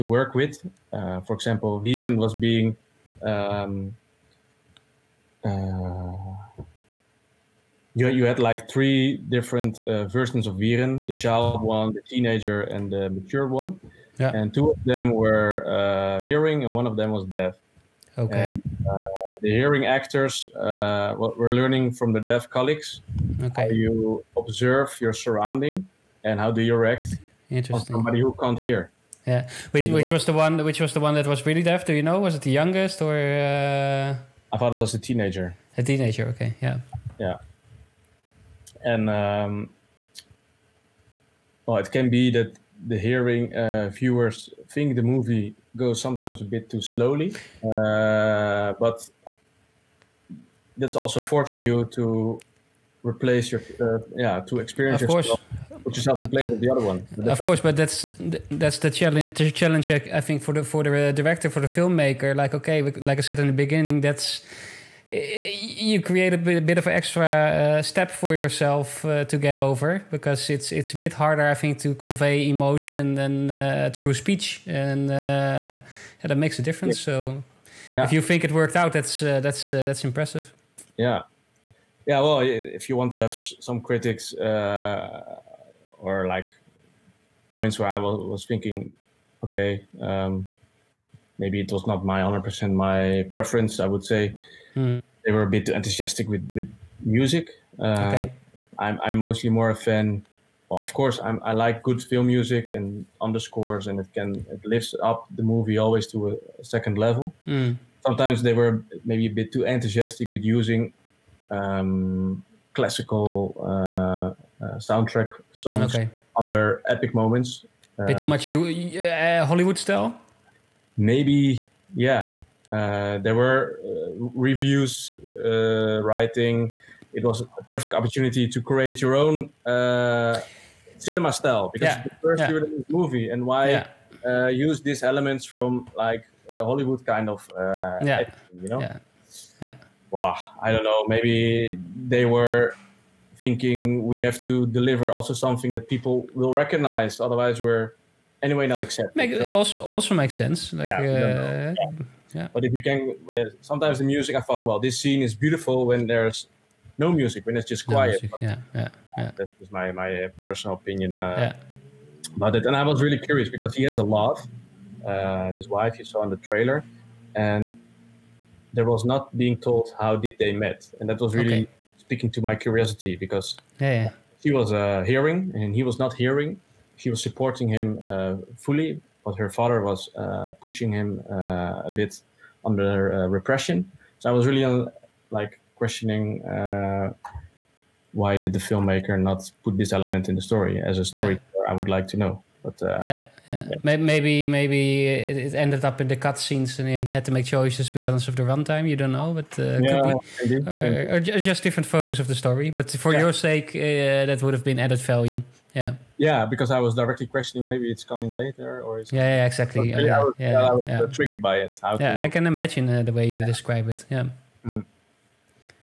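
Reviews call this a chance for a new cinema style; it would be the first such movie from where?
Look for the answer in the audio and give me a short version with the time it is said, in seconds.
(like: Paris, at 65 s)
European, at 132 s.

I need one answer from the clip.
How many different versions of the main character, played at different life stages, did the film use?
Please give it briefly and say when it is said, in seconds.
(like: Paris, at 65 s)
3, at 8 s.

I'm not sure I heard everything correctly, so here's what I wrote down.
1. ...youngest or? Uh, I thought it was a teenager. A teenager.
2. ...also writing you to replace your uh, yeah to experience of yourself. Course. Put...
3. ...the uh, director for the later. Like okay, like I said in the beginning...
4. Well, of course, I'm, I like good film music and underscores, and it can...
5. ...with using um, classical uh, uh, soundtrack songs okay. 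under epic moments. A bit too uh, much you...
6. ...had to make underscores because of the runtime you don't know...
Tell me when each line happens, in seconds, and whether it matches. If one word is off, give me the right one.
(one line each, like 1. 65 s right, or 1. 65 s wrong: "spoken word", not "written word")
1. 32 s right
2. 50 s wrong: "forcing", not "writing"
3. 60 s wrong: "filmmaker", not "later"
4. 100 s right
5. 110 s right
6. 197 s wrong: "choices", not "underscores".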